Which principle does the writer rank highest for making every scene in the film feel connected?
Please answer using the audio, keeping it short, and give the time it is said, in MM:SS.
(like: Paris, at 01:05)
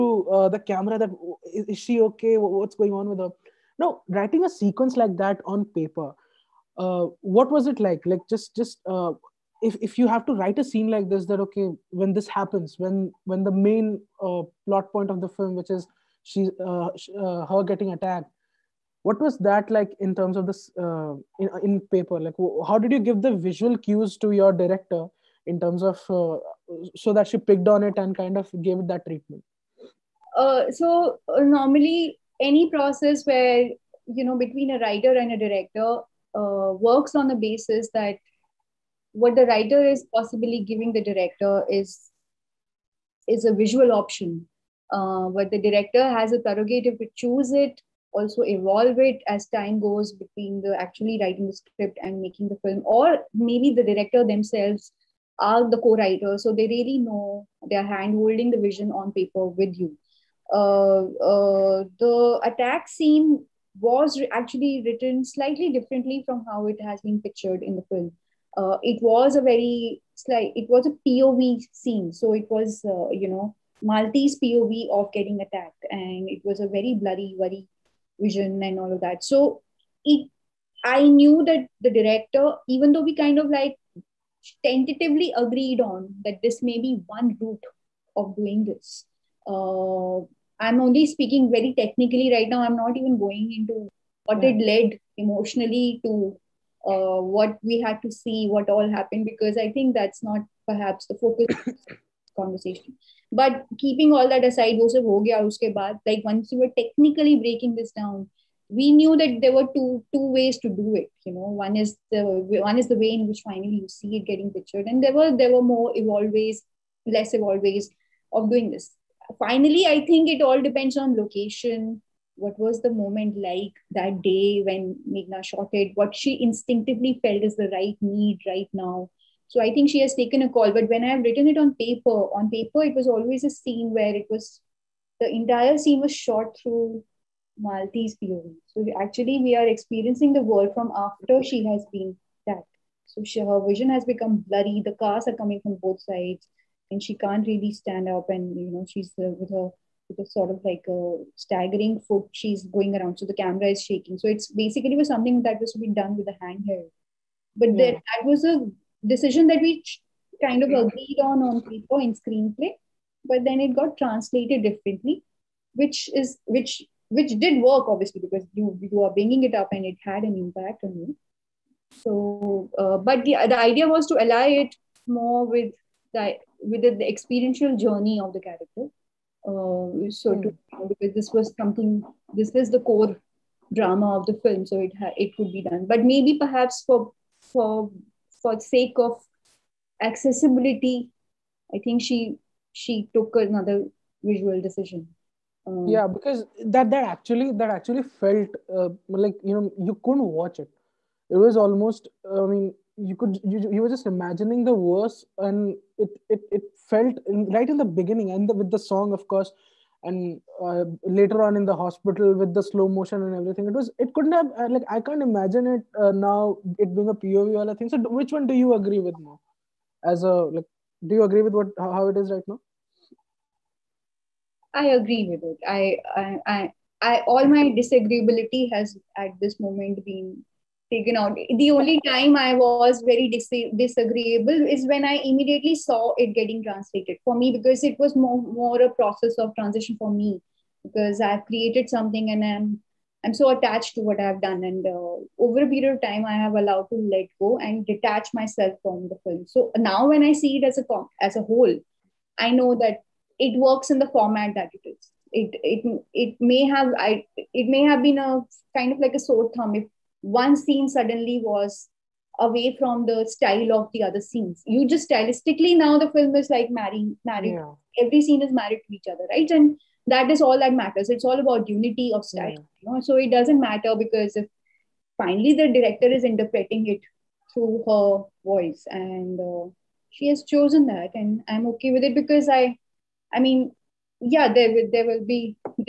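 Unity of style, at 04:31.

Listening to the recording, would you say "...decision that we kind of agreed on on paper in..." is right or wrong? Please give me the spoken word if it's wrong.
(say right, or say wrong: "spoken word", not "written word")
right.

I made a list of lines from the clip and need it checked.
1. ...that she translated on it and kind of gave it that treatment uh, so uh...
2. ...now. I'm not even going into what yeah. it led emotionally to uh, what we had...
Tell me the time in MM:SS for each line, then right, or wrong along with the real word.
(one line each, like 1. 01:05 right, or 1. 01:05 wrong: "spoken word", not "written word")
1. 00:27 wrong: "picked", not "translated"
2. 01:32 right.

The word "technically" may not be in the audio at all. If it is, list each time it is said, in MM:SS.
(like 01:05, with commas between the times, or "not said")
01:31, 01:46.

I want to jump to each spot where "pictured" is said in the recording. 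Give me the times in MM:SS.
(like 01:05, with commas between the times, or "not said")
01:07, 01:54.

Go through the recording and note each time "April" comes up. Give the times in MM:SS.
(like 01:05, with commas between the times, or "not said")
not said.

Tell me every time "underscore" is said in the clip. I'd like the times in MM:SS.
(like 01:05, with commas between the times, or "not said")
not said.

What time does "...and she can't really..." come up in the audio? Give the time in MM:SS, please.
02:26.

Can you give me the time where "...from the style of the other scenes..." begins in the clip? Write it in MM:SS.
04:22.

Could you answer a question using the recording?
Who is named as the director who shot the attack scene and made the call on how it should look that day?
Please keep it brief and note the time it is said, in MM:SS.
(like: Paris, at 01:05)
Meghna, at 02:05.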